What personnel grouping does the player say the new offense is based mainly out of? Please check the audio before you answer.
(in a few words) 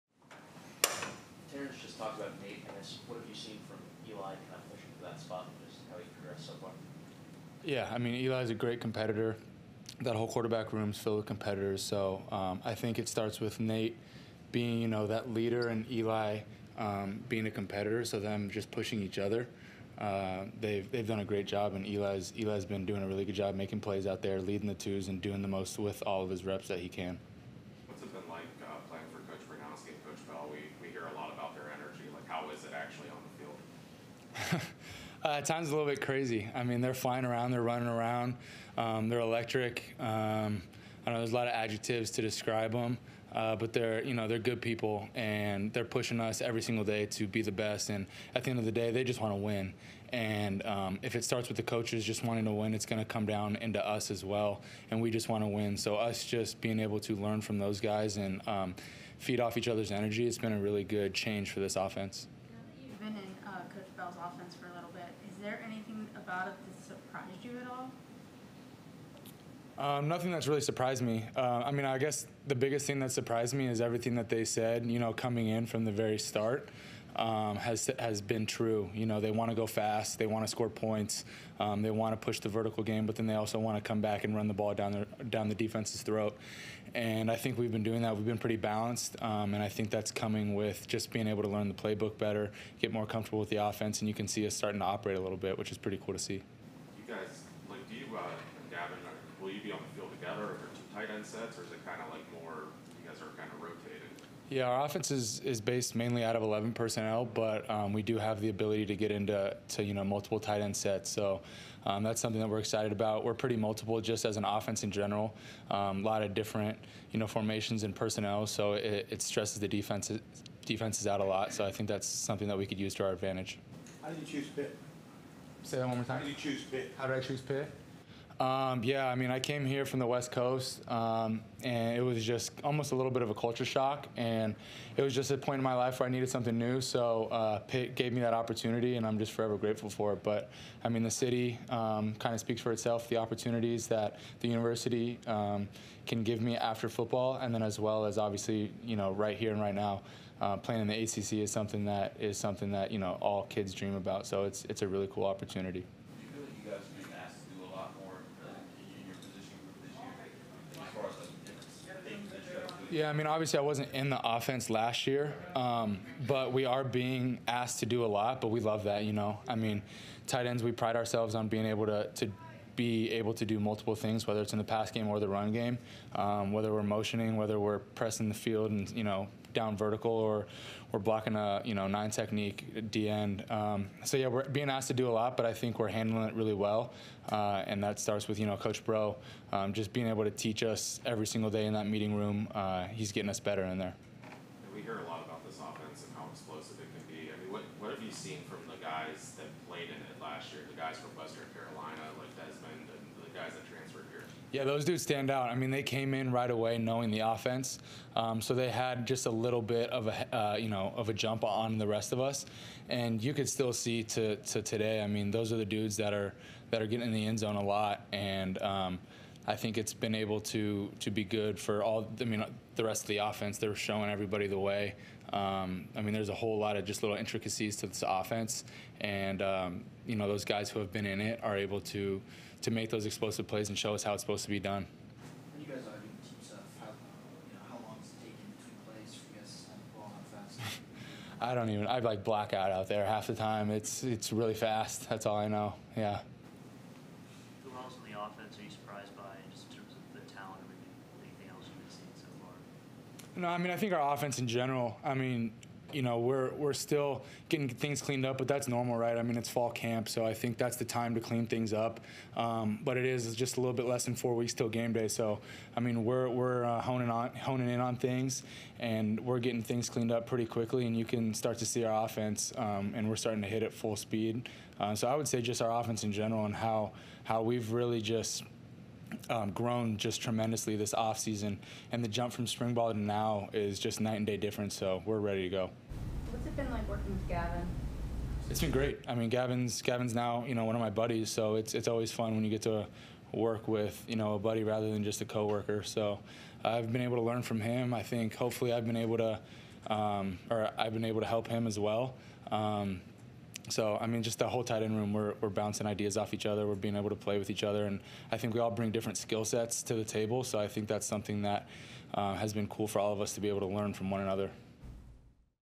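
11 personnel.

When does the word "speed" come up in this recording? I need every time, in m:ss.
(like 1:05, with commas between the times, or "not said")
4:33.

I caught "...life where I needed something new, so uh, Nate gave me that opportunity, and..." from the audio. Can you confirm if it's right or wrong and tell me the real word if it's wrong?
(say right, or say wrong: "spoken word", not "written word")
wrong: "Pitt", not "Nate".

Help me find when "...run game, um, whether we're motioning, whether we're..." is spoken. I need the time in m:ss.
2:55.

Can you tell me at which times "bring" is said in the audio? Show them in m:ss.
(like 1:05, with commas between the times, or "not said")
5:08.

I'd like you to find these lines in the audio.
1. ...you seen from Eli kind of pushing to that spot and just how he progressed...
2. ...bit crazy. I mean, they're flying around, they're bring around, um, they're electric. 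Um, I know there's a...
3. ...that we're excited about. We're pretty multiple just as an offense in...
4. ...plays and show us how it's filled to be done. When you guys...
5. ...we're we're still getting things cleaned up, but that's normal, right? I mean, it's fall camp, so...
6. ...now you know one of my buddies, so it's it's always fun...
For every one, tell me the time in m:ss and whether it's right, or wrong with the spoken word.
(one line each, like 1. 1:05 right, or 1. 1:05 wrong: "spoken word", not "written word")
1. 0:03 right
2. 0:35 wrong: "running", not "bring"
3. 1:52 right
4. 3:53 wrong: "supposed", not "filled"
5. 4:16 right
6. 4:50 right.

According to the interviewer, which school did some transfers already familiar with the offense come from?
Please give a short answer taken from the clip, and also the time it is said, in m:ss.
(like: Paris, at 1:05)
Western Carolina, at 3:21.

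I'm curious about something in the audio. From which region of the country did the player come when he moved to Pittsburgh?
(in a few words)
West Coast.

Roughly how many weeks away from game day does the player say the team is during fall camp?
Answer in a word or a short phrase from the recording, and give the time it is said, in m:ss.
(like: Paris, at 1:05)
4, at 4:24.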